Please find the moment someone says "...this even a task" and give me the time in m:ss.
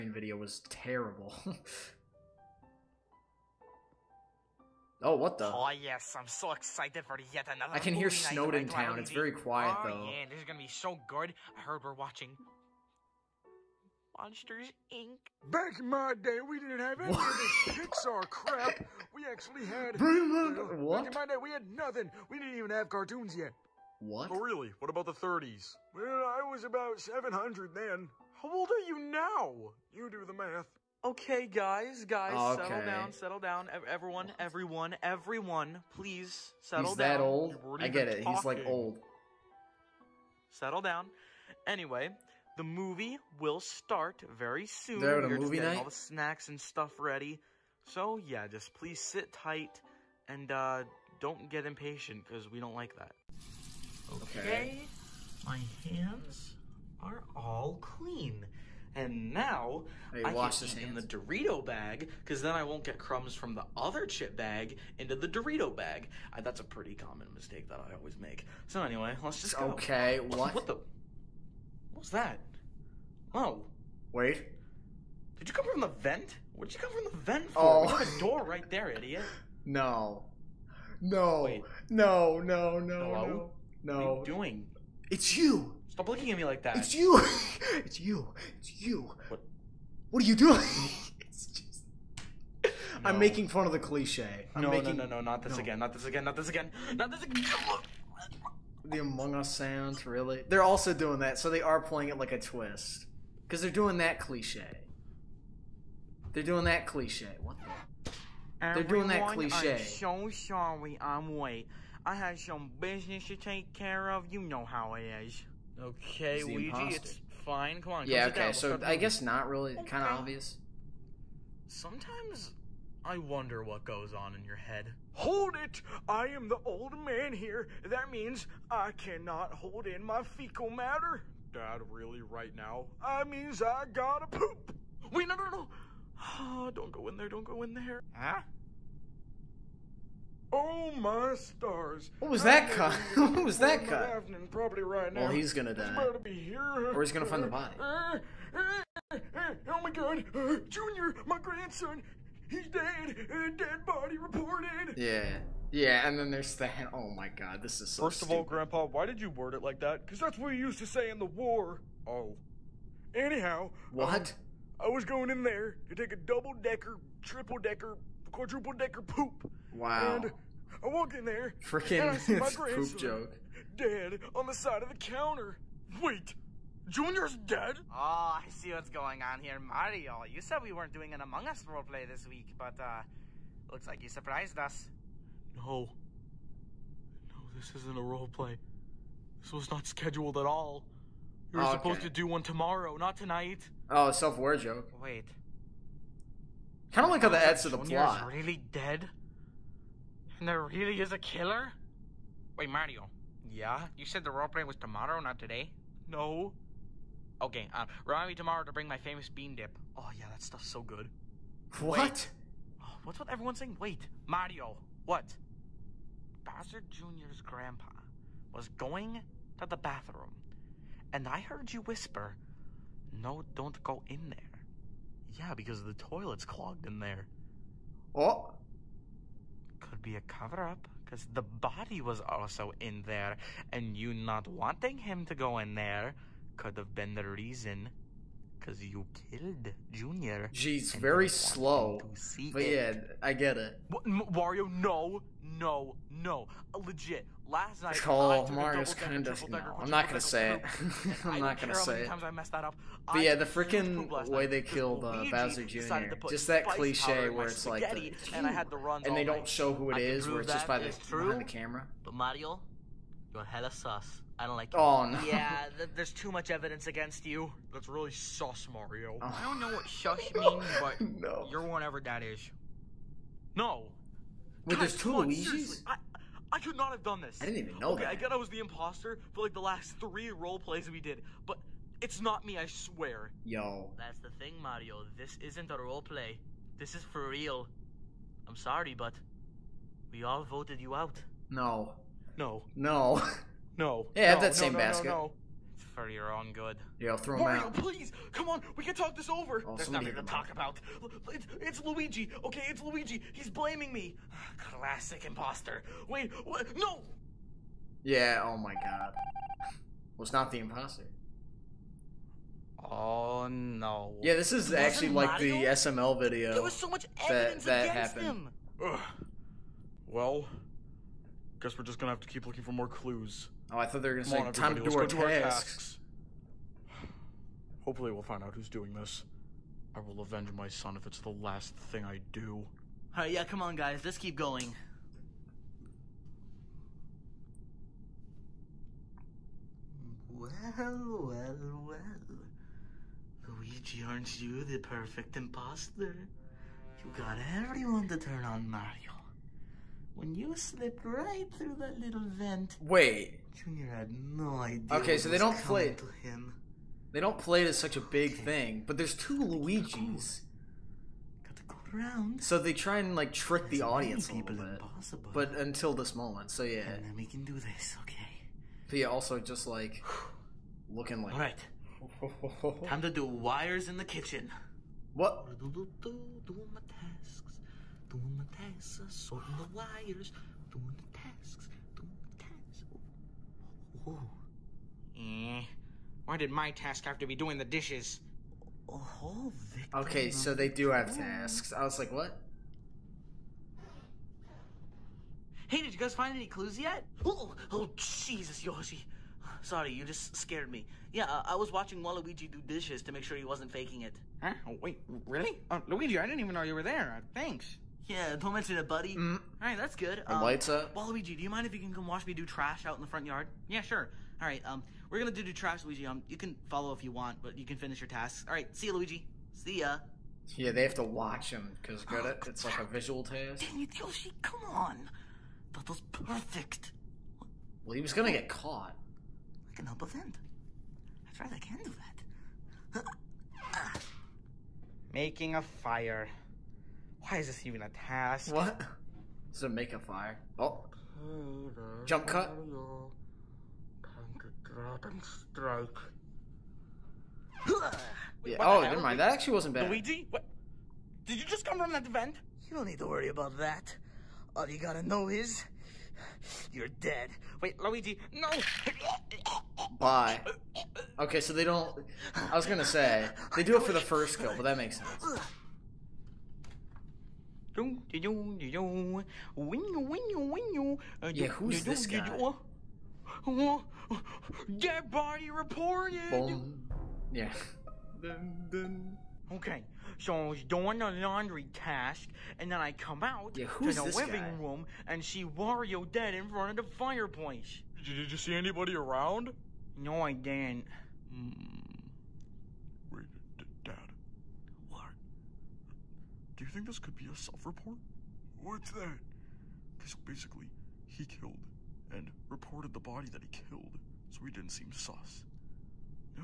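7:17.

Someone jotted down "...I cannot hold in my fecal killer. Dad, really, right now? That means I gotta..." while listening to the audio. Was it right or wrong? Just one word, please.
wrong.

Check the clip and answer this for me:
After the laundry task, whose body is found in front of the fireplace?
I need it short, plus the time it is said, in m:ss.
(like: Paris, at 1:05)
Wario, at 8:05.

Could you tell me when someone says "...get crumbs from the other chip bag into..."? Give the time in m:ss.
1:02.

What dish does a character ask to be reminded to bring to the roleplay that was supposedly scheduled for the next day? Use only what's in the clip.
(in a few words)
Bean dip.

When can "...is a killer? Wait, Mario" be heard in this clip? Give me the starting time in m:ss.
3:20.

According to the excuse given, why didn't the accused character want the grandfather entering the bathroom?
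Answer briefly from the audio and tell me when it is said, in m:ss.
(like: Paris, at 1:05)
The toilet's clogged, at 3:45.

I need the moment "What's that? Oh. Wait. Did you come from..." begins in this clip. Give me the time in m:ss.
1:11.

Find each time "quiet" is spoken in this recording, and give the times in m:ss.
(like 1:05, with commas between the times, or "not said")
0:09.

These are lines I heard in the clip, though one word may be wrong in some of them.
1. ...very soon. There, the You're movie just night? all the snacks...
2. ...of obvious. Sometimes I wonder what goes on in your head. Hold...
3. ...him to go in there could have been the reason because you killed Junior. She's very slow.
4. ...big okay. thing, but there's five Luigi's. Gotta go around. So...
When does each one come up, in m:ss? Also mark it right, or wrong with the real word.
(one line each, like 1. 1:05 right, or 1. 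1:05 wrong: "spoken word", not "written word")
1. 0:44 right
2. 2:00 right
3. 3:54 right
4. 5:57 wrong: "two", not "five".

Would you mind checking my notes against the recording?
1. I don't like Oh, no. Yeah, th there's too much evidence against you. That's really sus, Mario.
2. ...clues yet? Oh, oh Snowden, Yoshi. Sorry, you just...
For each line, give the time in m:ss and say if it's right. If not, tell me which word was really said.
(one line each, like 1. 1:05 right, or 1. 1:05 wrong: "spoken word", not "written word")
1. 4:24 right
2. 6:36 wrong: "Jesus", not "Snowden".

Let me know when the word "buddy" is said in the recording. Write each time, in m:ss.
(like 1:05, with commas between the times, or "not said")
6:48.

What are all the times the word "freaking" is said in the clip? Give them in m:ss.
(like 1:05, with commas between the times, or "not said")
2:51, 4:13.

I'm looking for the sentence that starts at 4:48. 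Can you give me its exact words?
I'm sorry, but we all voted you out.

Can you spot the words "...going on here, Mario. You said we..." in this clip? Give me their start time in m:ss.
2:58.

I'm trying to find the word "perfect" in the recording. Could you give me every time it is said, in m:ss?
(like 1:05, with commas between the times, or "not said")
5:44, 7:06.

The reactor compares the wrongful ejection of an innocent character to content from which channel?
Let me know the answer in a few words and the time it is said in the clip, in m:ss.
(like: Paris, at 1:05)
SML, at 5:15.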